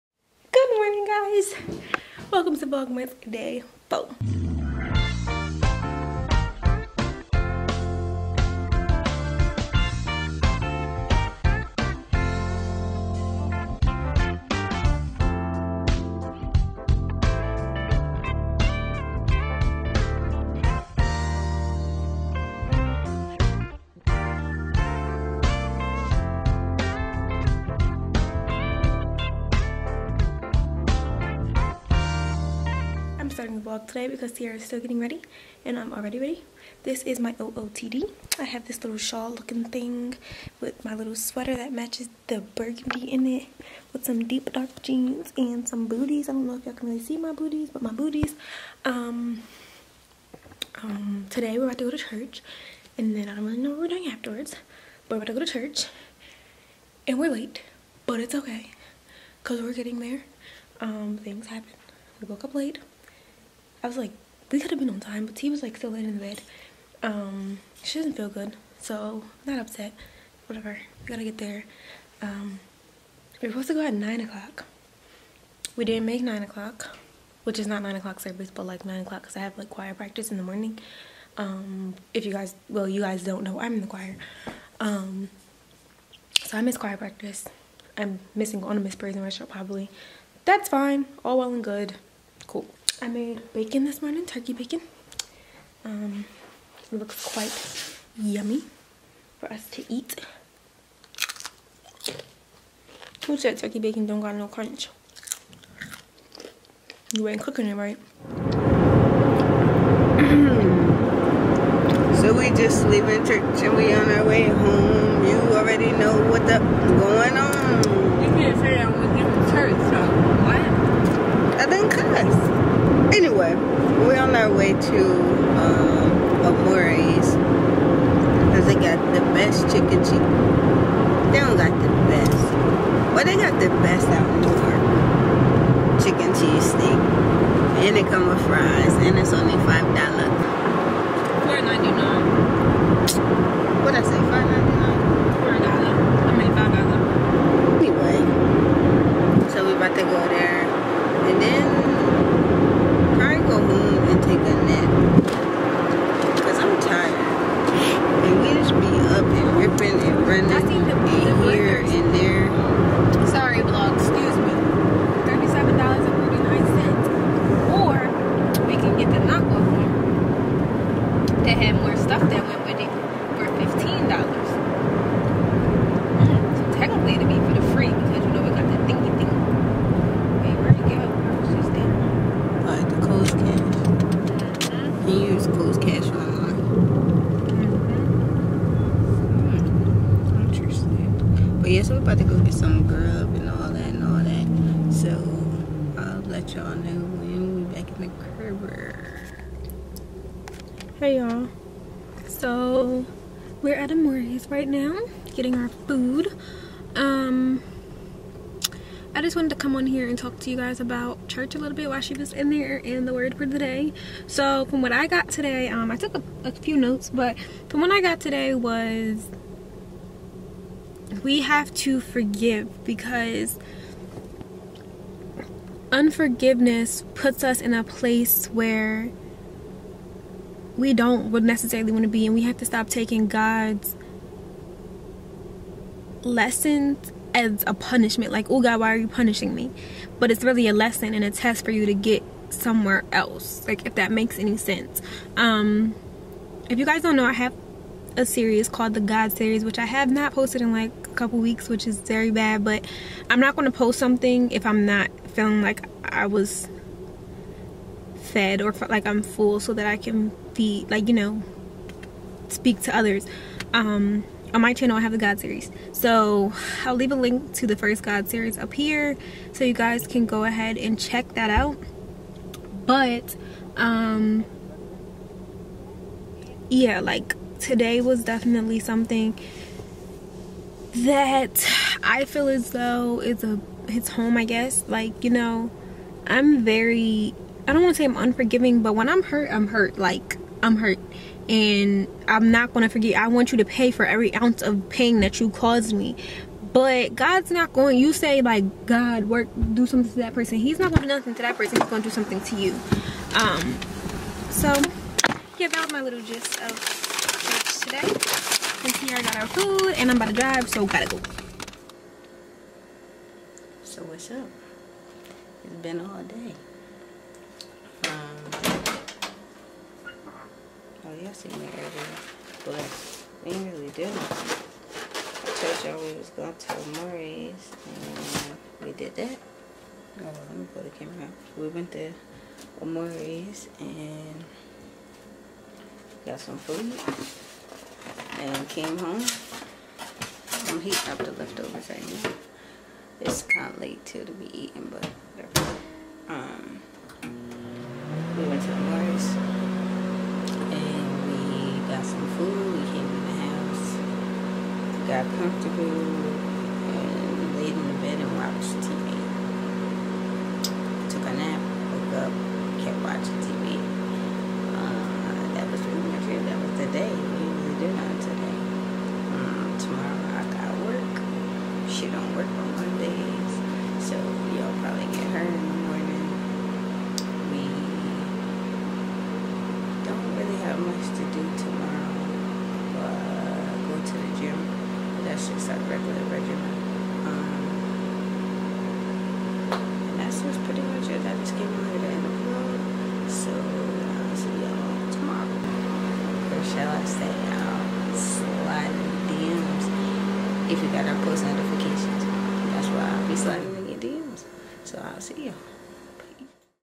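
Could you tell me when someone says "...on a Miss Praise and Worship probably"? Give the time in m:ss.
1:28.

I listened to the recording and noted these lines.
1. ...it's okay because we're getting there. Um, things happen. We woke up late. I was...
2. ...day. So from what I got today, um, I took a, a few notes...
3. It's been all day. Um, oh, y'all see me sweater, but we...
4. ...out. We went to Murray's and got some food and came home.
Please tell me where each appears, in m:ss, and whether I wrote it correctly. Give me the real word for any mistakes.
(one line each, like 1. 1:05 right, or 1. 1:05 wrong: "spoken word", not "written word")
1. 0:58 right
2. 3:33 right
3. 5:15 wrong: "earlier", not "sweater"
4. 5:31 right.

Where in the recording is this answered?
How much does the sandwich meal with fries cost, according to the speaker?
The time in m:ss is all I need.
2:19.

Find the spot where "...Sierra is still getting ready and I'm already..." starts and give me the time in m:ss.
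0:34.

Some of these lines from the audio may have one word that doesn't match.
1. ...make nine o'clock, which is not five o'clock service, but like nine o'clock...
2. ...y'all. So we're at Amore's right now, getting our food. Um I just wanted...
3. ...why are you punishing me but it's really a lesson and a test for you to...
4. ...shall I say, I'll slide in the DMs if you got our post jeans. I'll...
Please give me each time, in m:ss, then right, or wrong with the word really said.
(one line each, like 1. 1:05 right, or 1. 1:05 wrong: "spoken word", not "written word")
1. 1:16 wrong: "nine", not "five"
2. 3:21 right
3. 3:58 right
4. 6:36 wrong: "notifications", not "jeans".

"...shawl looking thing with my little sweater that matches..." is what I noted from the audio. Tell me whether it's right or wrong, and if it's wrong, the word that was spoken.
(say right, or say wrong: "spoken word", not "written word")
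right.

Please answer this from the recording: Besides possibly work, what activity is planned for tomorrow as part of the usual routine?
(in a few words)
Go to the gym.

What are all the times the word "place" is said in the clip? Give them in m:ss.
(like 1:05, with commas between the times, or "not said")
3:47.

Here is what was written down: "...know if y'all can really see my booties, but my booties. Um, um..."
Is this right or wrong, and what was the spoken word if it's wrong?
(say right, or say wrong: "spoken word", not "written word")
right.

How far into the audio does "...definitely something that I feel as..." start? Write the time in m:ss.
4:38.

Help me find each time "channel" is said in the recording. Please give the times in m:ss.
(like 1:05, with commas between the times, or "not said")
4:24.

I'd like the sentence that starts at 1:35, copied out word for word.
Um, it looks quite yummy for us to eat.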